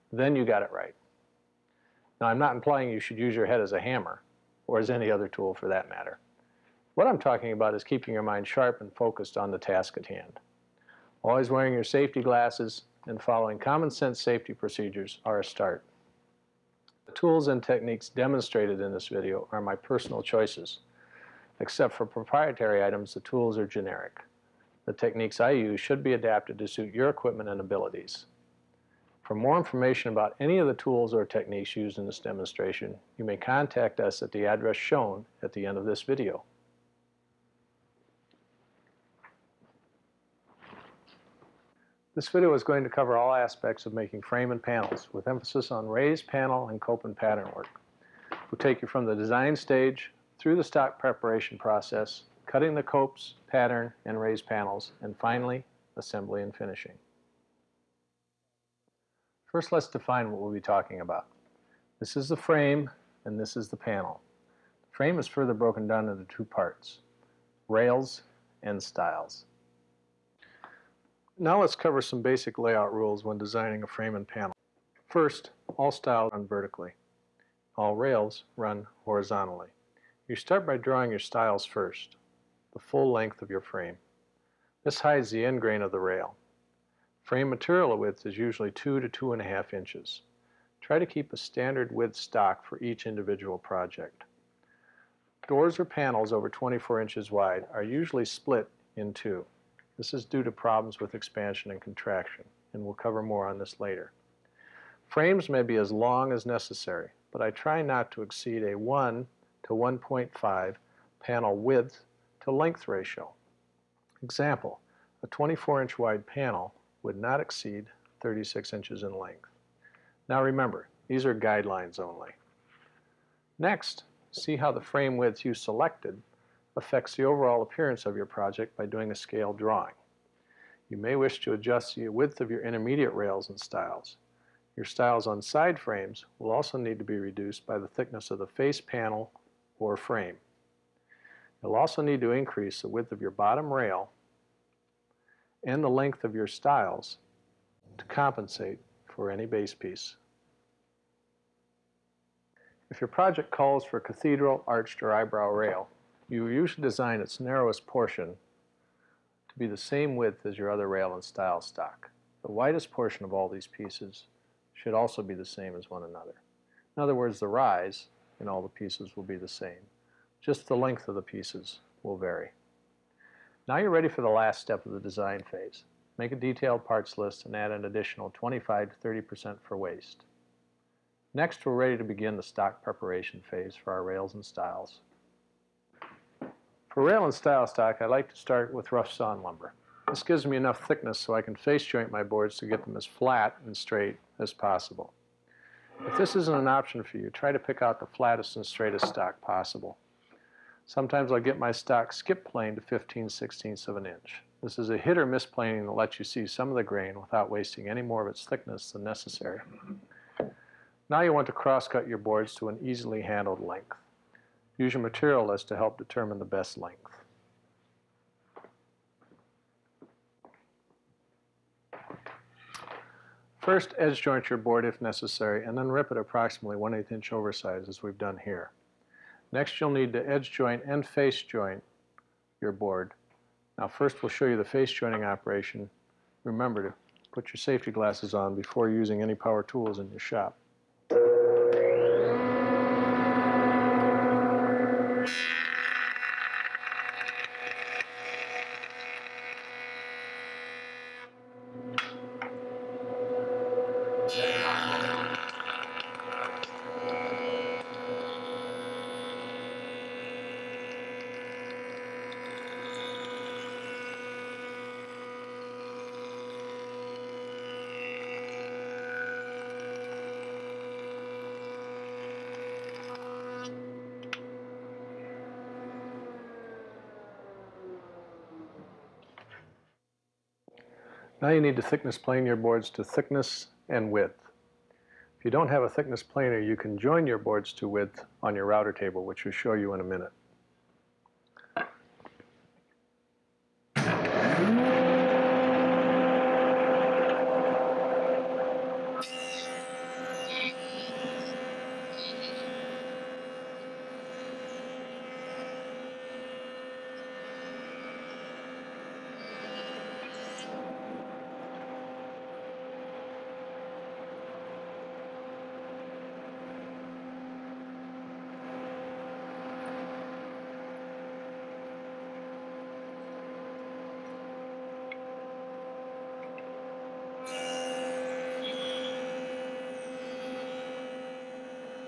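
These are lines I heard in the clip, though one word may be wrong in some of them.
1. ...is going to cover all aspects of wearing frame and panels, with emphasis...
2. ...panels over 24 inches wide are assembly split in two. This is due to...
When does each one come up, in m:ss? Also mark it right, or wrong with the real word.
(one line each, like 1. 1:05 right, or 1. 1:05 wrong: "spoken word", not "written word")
1. 0:42 wrong: "making", not "wearing"
2. 1:35 wrong: "usually", not "assembly".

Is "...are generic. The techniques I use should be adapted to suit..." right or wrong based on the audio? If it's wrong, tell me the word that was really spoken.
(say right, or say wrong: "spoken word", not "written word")
right.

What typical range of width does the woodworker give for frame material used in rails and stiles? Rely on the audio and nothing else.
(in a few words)
2 to 2.5 inches.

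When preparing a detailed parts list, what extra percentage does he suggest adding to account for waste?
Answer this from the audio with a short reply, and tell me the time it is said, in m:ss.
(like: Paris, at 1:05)
25 to 30%, at 2:58.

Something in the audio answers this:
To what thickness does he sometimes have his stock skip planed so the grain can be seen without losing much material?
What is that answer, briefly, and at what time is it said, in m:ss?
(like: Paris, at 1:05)
15/16 inch, at 3:22.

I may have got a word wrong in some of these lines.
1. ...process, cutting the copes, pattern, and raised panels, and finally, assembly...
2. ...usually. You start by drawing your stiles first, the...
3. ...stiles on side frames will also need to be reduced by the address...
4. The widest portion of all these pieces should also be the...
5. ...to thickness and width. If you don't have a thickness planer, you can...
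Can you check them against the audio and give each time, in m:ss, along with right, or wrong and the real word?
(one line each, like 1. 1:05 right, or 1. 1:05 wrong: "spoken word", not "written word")
1. 0:51 right
2. 1:19 wrong: "horizontally", not "usually"
3. 2:14 wrong: "thickness", not "address"
4. 2:42 right
5. 4:42 right.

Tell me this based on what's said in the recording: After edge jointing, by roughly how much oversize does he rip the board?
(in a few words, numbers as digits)
1/8 inch.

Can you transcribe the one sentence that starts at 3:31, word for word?
Now you want to cross-cut your boards to an easily handled length.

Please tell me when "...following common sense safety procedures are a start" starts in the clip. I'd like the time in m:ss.
0:13.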